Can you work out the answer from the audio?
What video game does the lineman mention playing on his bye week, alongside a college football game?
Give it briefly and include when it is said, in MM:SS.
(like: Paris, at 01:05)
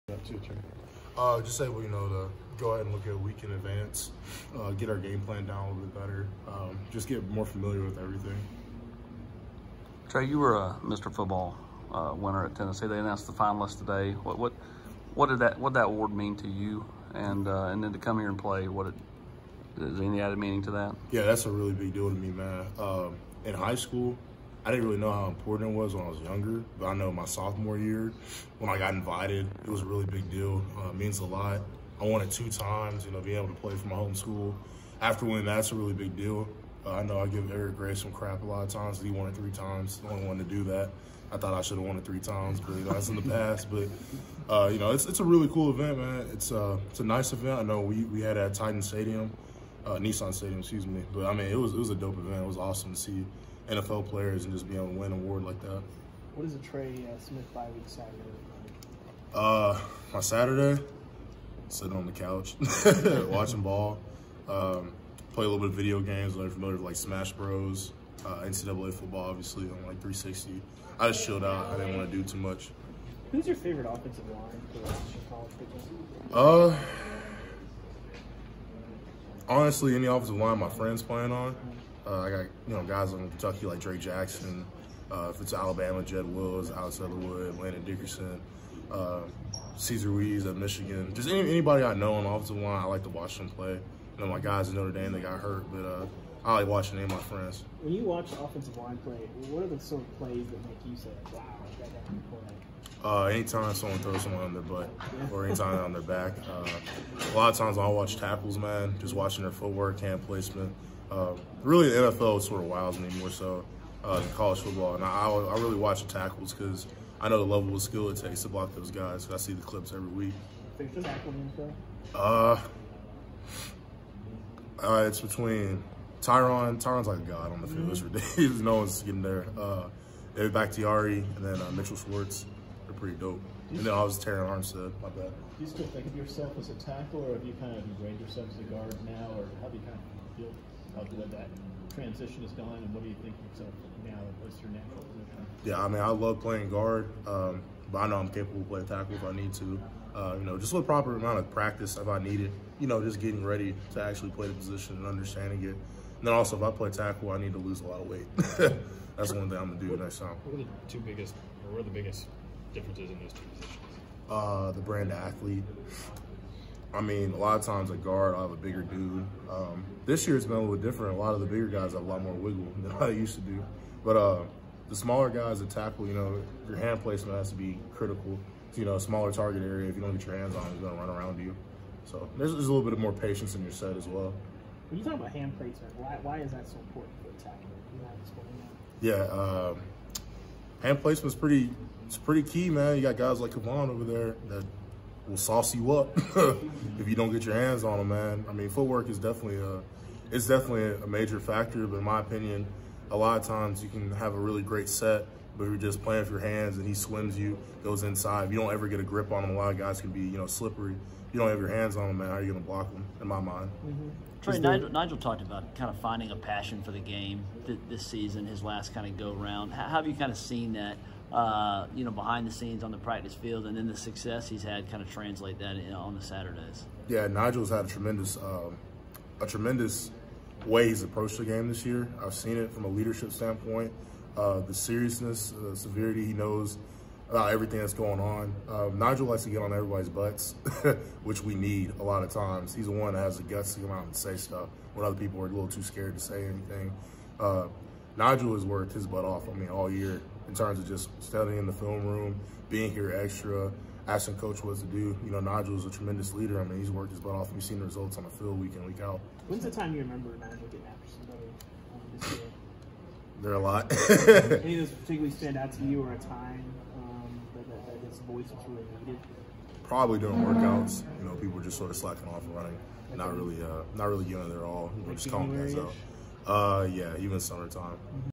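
Smash Bros, at 01:06.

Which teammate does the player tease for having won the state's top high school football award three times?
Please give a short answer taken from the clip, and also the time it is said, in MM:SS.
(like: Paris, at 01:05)
Eric Gray, at 00:37.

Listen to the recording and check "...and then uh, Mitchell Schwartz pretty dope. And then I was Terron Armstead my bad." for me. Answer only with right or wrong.
right.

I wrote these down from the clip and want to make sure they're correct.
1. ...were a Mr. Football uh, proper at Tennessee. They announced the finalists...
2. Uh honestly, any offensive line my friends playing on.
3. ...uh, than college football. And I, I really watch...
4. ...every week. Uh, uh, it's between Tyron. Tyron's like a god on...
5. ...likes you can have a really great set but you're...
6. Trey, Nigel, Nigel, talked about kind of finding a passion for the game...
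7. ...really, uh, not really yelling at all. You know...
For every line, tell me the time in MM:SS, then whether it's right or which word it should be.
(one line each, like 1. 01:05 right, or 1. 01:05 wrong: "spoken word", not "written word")
1. 00:10 wrong: "winner", not "proper"
2. 01:16 right
3. 01:54 right
4. 01:59 right
5. 03:23 wrong: "times", not "likes"
6. 03:34 right
7. 04:33 right.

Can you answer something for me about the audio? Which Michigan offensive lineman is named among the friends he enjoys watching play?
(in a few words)
Cesar Ruiz.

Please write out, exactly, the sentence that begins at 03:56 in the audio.
He knows about everything that's going on.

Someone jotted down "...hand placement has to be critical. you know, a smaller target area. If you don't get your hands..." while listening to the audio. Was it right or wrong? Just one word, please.
right.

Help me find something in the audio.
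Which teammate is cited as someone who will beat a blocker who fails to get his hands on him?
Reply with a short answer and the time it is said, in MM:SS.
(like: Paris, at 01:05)
Kivon, at 03:13.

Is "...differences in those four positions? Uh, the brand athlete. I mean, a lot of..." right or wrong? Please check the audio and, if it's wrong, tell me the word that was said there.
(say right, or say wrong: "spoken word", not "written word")
wrong: "two", not "four".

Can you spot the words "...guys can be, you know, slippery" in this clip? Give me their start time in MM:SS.
03:29.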